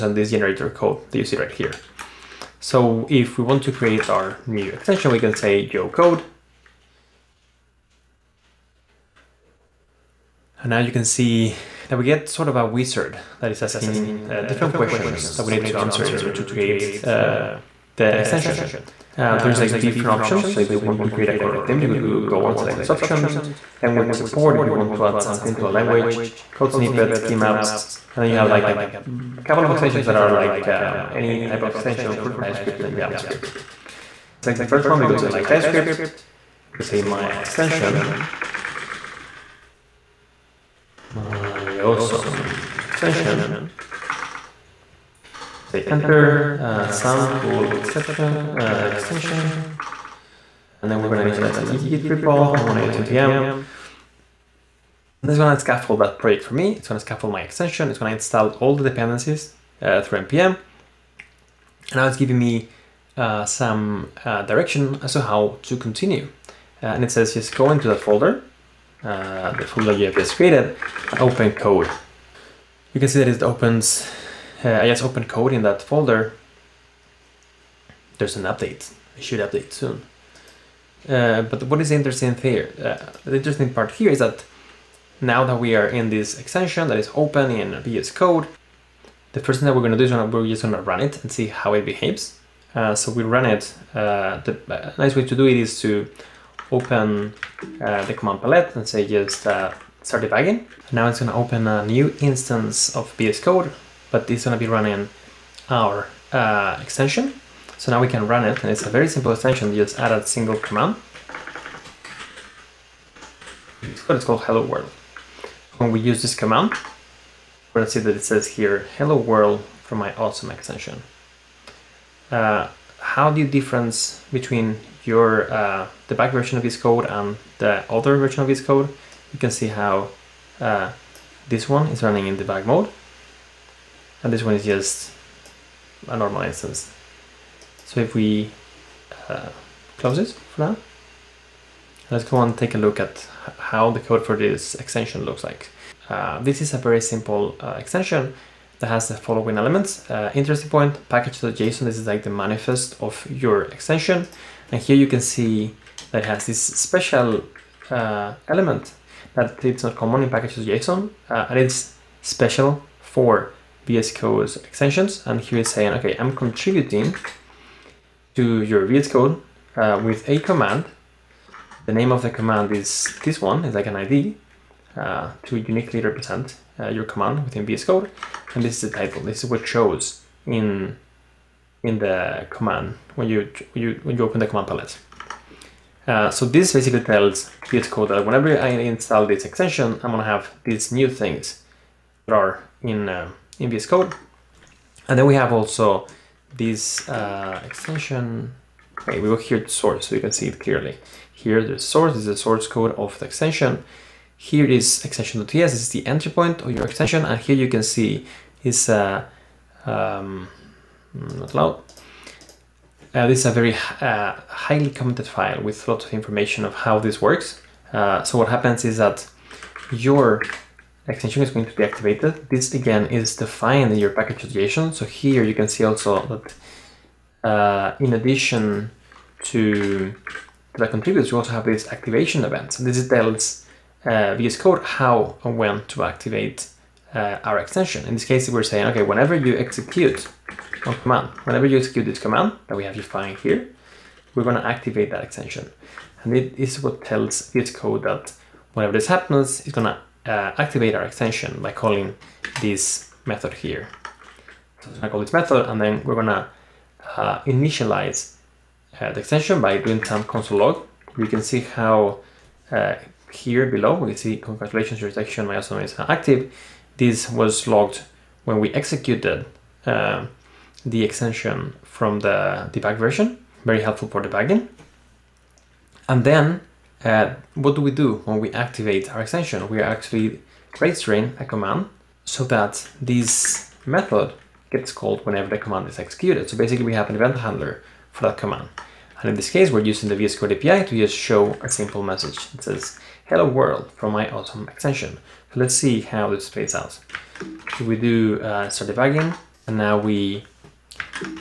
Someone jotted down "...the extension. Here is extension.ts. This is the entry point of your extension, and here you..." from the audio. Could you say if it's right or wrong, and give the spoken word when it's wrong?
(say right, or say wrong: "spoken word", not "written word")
right.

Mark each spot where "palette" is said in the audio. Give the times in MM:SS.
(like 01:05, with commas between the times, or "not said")
01:38, 03:04.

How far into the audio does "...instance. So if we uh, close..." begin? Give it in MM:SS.
02:16.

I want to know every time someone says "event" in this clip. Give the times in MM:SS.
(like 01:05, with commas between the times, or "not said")
03:52, 04:47.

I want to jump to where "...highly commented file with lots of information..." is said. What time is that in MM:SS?
03:34.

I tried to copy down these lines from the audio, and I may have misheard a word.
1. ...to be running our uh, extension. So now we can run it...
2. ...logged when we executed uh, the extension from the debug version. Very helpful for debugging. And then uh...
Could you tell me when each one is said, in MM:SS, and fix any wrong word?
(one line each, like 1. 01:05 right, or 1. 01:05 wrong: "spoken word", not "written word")
1. 01:44 right
2. 04:27 right.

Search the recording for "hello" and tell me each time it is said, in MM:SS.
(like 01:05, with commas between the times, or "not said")
01:54, 01:58, 04:53.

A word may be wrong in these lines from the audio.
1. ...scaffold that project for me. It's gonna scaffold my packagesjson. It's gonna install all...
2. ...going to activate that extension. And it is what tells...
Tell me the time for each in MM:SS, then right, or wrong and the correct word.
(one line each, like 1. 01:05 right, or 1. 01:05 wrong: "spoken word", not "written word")
1. 00:55 wrong: "extension", not "packagesjson"
2. 04:04 right.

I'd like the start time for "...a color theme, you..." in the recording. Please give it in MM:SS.
00:21.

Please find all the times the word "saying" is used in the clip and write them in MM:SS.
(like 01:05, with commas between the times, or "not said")
02:45, 03:58.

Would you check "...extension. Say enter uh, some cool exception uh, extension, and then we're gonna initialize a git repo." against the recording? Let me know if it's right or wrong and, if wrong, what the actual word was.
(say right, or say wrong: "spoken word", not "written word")
right.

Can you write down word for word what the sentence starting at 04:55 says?
Let's see how this plays out.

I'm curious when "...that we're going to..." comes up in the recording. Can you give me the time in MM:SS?
01:29.